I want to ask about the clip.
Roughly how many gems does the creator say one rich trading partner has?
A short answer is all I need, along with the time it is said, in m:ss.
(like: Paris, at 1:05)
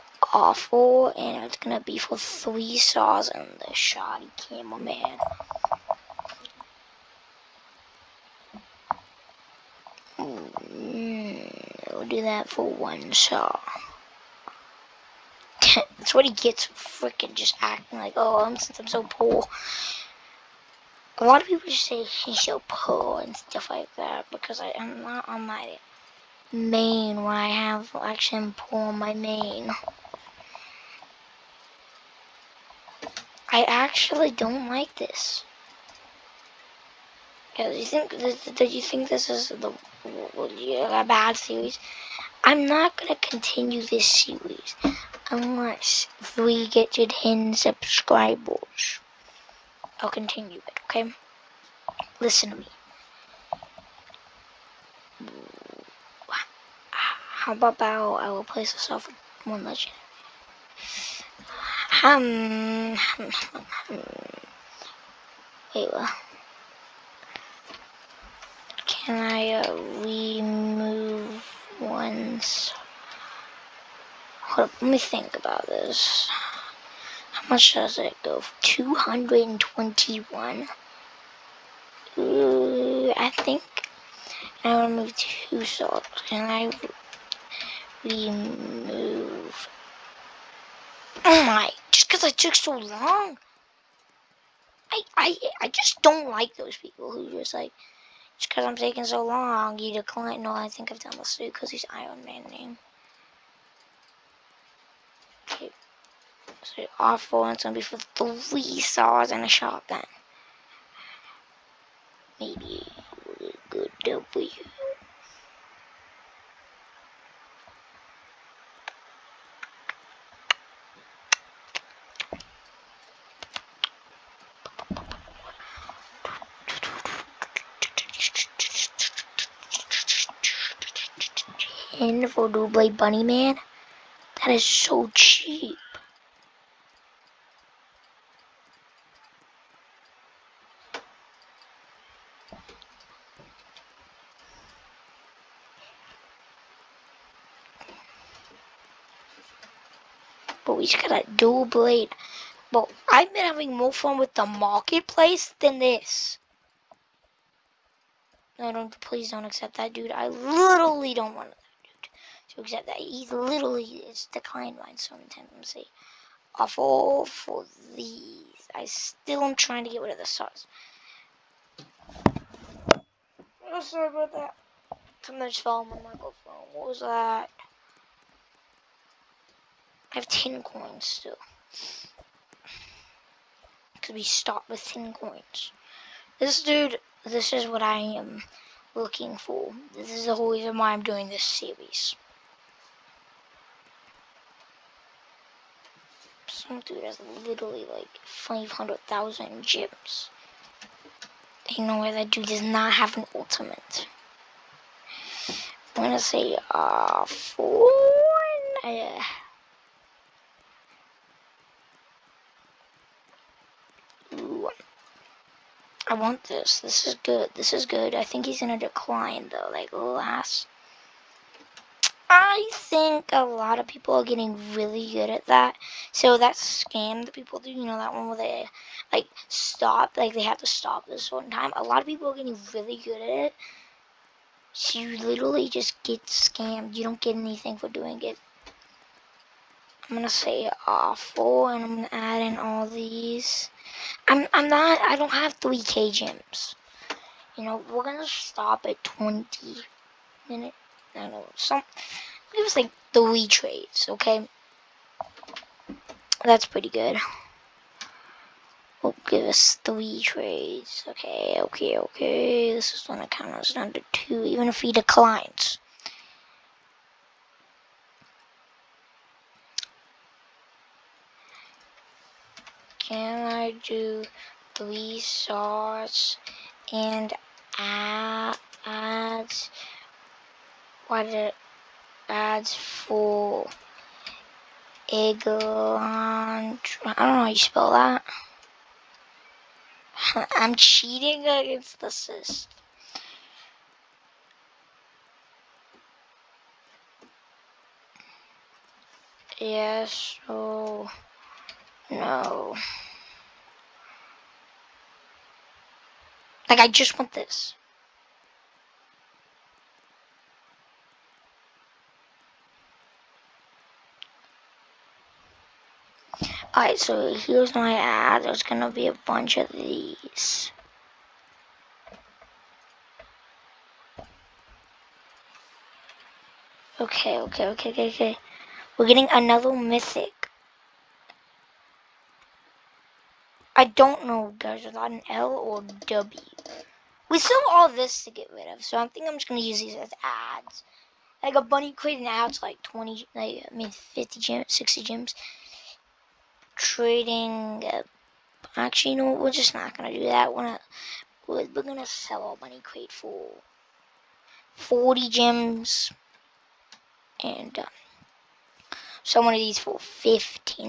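500,000, at 3:18.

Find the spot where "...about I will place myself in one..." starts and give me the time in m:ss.
0:57.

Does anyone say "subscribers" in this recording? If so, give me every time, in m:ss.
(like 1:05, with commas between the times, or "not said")
0:47.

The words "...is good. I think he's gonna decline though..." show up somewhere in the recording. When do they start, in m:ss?
3:37.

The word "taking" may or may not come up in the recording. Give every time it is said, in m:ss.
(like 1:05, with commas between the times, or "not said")
1:38.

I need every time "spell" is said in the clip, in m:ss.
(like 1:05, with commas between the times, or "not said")
4:47.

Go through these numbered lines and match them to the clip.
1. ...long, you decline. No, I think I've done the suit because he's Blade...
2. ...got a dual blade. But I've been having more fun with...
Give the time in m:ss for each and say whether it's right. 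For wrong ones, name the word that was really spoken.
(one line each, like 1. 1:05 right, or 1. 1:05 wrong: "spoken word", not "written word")
1. 1:39 wrong: "Iron", not "Blade"
2. 2:31 right.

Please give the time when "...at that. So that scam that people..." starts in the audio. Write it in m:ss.
3:45.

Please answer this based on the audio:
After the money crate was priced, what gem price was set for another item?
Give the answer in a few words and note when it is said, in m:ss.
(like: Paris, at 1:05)
15, at 5:59.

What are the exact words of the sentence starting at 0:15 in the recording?
That's what he gets freaking just acting like, oh, I'm, since I'm so poor.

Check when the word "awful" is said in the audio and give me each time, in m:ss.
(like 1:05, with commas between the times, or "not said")
0:00, 1:46, 4:00.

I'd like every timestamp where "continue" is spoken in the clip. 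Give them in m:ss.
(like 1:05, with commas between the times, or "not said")
0:43, 0:50.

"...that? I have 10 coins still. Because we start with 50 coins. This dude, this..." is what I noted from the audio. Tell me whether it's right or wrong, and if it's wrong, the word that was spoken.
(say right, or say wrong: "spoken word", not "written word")
wrong: "10", not "50".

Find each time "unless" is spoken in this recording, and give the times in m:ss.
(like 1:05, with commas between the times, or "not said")
0:45.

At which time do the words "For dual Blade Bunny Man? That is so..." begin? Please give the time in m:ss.
2:12.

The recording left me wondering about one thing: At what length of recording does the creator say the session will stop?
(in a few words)
20 minutes.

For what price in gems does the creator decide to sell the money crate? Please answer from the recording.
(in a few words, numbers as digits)
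40 gems.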